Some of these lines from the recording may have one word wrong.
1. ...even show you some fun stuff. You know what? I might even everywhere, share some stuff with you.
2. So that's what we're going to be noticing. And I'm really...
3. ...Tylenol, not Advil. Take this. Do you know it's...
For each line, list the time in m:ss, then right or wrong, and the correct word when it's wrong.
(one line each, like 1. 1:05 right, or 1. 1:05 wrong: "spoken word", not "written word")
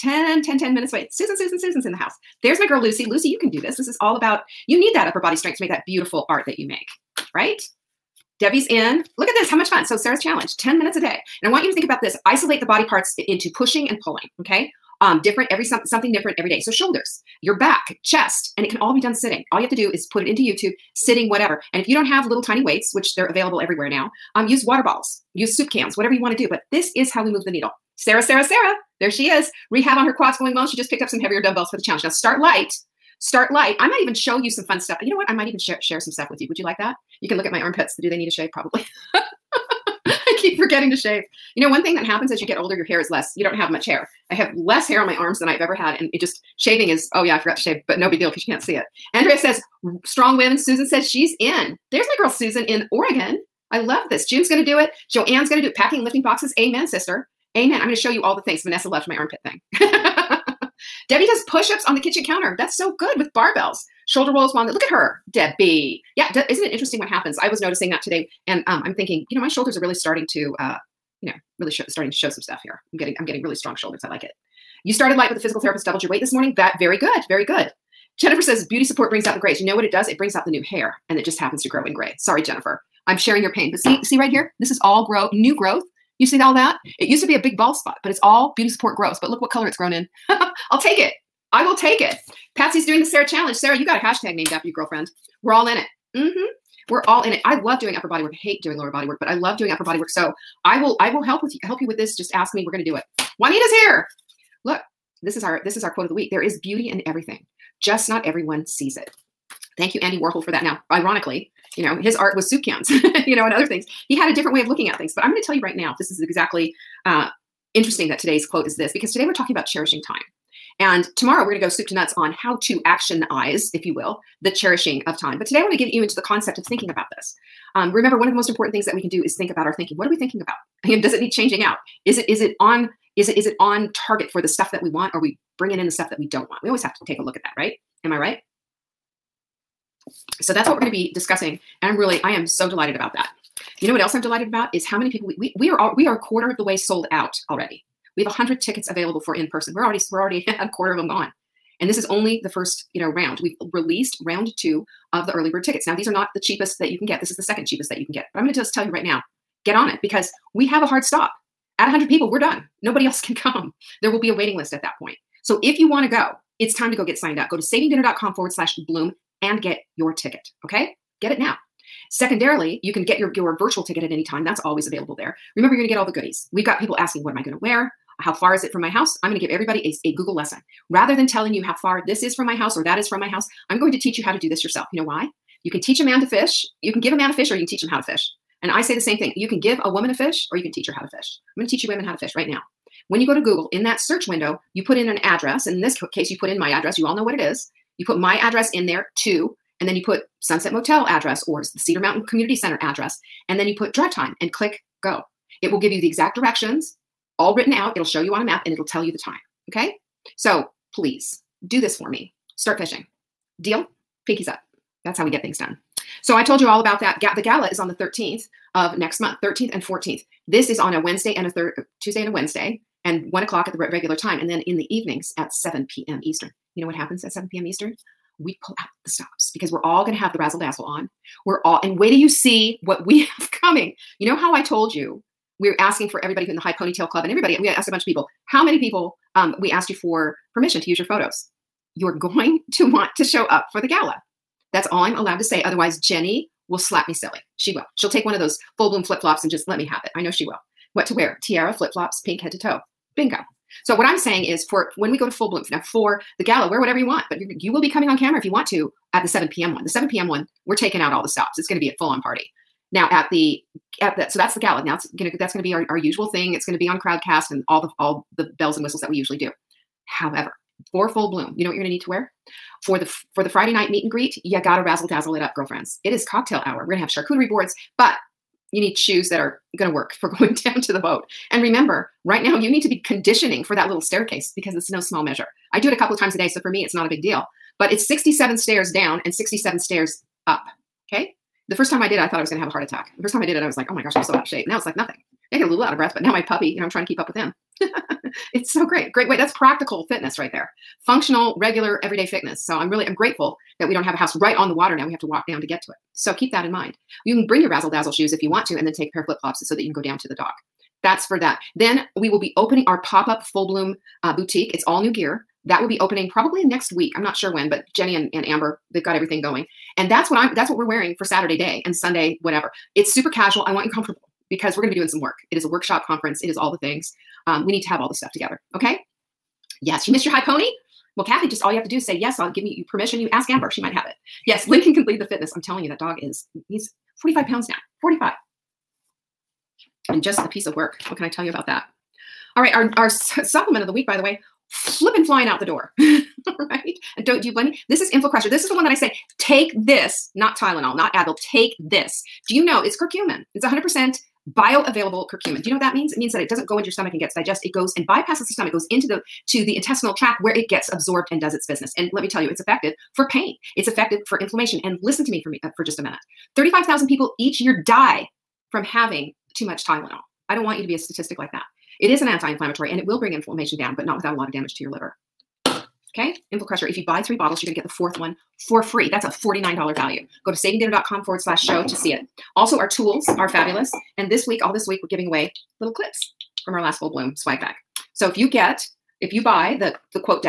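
1. 0:34 wrong: "share", not "everywhere"
2. 2:20 wrong: "discussing", not "noticing"
3. 5:50 right.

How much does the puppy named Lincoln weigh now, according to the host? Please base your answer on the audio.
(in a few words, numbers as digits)
45 pounds.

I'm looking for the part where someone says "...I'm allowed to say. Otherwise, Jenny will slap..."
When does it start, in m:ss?
4:05.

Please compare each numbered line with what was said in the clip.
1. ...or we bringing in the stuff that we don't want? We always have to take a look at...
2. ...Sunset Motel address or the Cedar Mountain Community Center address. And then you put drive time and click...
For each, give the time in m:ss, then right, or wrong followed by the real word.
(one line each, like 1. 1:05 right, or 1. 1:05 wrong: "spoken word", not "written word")
1. 2:15 right
2. 3:20 right.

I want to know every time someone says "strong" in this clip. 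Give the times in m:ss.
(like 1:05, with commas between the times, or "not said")
0:50, 1:13.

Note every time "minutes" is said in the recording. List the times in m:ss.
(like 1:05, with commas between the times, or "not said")
0:00, 0:10, 6:06.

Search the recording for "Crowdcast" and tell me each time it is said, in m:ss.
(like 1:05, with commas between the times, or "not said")
4:26.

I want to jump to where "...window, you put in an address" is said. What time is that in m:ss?
3:14.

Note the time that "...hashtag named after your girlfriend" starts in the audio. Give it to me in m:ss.
1:33.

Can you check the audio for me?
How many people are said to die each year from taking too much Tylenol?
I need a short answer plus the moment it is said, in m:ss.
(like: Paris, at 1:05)
35,000, at 6:06.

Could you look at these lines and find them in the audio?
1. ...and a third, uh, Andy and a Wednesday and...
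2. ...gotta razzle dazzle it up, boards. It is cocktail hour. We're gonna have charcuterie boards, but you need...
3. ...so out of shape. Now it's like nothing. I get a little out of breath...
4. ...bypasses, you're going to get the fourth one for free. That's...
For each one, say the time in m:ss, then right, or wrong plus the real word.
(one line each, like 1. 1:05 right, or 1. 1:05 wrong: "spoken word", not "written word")
1. 3:41 wrong: "Tuesday", not "Andy"
2. 4:34 wrong: "girlfriends", not "boards"
3. 4:54 right
4. 6:17 wrong: "bottles", not "bypasses".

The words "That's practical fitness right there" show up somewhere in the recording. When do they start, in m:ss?
4:59.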